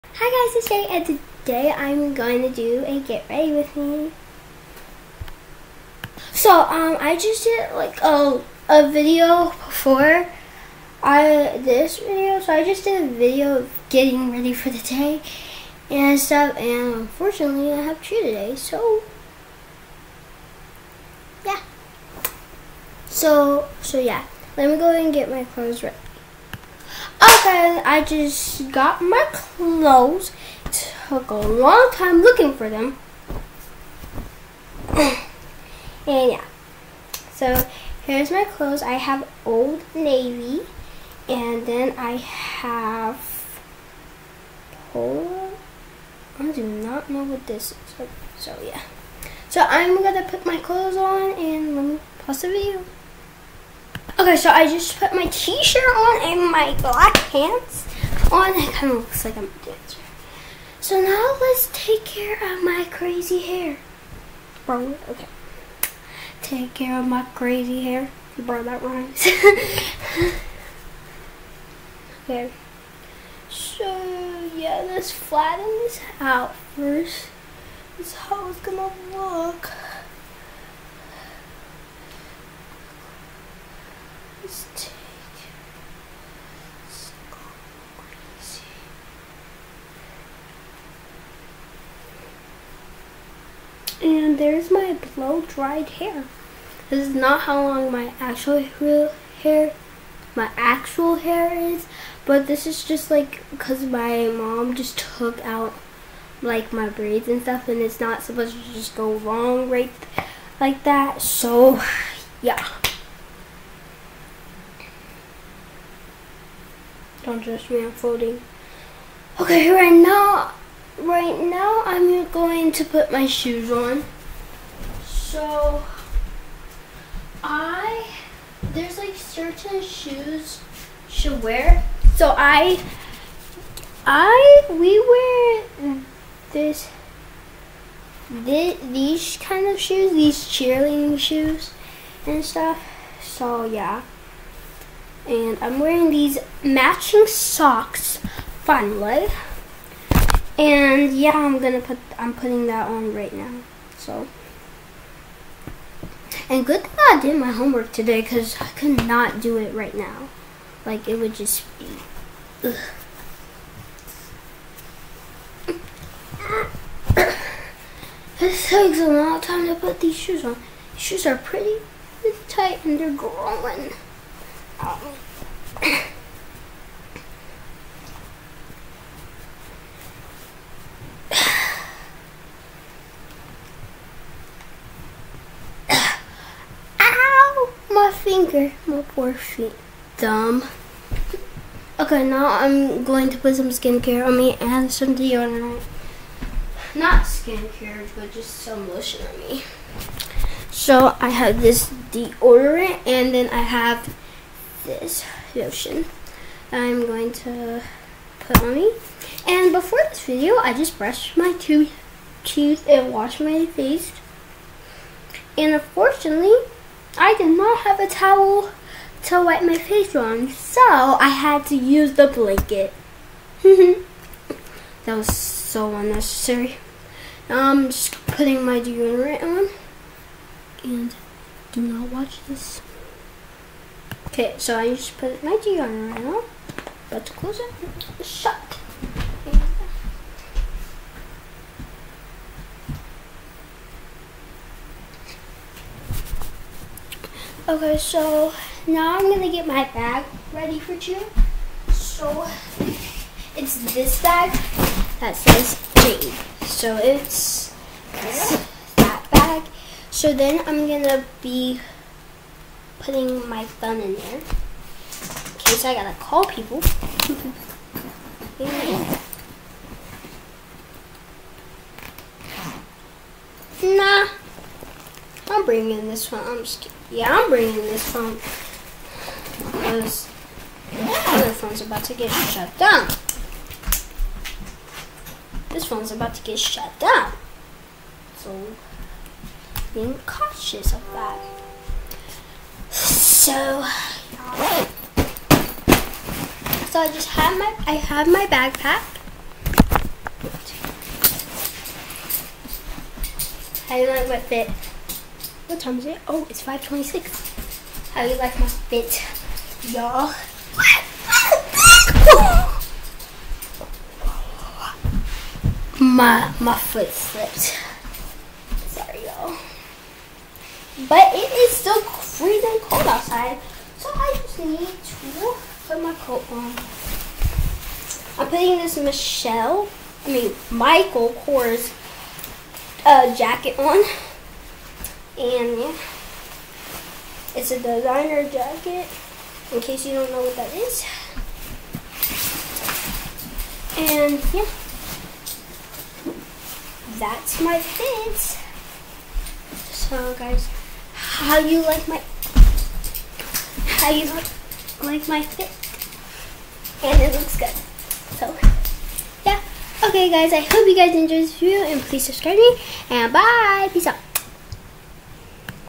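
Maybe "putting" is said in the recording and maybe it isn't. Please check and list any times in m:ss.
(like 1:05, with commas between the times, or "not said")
2:32, 3:48, 4:23, 5:28.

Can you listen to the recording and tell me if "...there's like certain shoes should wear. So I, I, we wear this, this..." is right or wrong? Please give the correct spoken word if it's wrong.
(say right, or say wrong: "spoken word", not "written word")
right.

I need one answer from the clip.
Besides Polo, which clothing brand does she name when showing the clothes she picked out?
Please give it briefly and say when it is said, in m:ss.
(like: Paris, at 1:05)
Old Navy, at 0:39.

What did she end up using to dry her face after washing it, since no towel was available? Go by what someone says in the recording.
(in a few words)
The blanket.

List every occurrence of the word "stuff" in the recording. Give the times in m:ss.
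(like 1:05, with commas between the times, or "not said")
0:16, 1:47, 2:22.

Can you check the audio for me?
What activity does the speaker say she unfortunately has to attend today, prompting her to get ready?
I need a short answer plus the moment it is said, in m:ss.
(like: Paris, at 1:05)
Cheer, at 0:18.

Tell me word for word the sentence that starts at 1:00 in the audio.
So now let's take care of my crazy hair.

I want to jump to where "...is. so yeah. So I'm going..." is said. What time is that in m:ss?
0:47.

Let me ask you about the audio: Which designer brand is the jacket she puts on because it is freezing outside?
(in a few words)
Michael Kors.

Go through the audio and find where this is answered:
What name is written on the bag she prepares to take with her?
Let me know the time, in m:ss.
4:15.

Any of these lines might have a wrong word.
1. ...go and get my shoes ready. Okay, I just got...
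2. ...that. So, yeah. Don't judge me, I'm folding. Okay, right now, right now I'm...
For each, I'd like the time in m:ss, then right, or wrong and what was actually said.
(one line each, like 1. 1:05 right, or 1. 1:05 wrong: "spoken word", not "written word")
1. 0:24 wrong: "clothes", not "shoes"
2. 1:50 right.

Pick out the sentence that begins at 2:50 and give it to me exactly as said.
These shoes are pretty, pretty tight and they're growing.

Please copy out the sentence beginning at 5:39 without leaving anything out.
In case you don't know what that is, and yeah, that's my fit.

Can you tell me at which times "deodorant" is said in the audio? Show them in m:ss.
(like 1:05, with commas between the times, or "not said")
3:15, 3:22, 3:48.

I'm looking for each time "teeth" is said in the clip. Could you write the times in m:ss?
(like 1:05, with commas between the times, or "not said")
3:32.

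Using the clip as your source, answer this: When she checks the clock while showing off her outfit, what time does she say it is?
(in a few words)
5:26.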